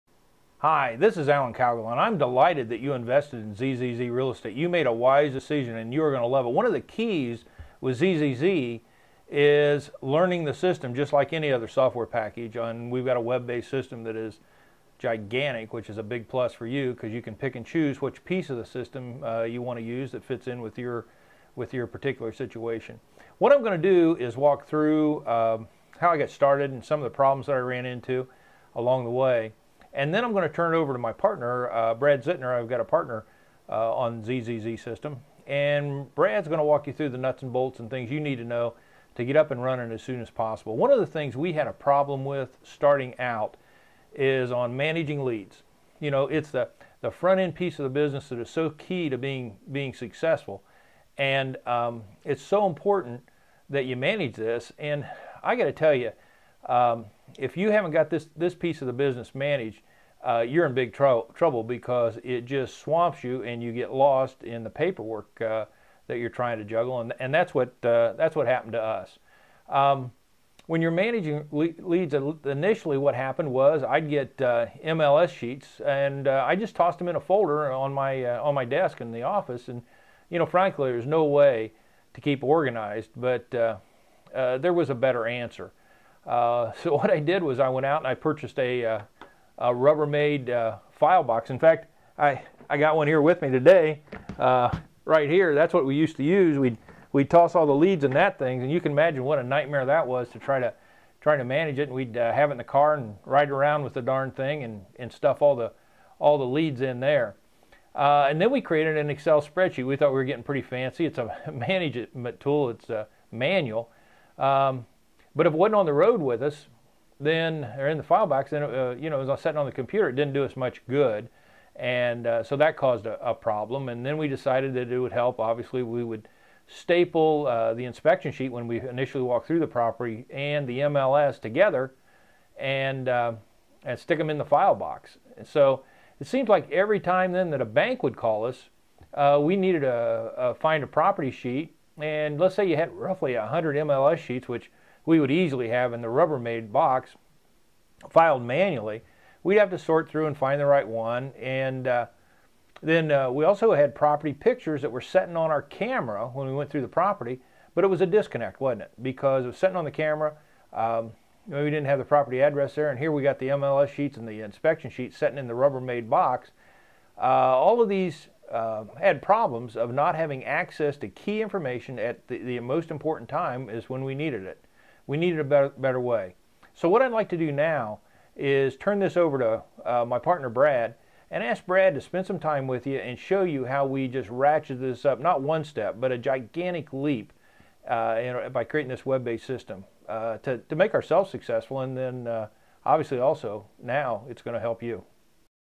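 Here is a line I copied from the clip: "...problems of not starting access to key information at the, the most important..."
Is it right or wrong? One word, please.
wrong.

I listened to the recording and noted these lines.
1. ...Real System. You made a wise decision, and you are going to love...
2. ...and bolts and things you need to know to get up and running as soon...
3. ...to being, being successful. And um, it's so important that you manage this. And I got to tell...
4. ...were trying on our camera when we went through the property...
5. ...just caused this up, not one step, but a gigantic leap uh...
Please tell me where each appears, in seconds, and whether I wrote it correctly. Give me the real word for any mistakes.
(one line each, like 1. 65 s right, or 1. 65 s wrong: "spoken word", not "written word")
1. 4 s wrong: "Estate", not "System"
2. 37 s right
3. 49 s right
4. 154 s wrong: "setting", not "trying"
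5. 184 s wrong: "ratcheted", not "caused".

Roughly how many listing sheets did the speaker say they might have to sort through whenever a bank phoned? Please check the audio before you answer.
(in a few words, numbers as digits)
100.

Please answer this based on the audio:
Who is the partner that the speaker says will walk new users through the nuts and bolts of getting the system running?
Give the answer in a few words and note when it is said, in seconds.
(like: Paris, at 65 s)
Brad Zittner, at 31 s.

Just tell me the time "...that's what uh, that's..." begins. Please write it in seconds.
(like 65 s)
67 s.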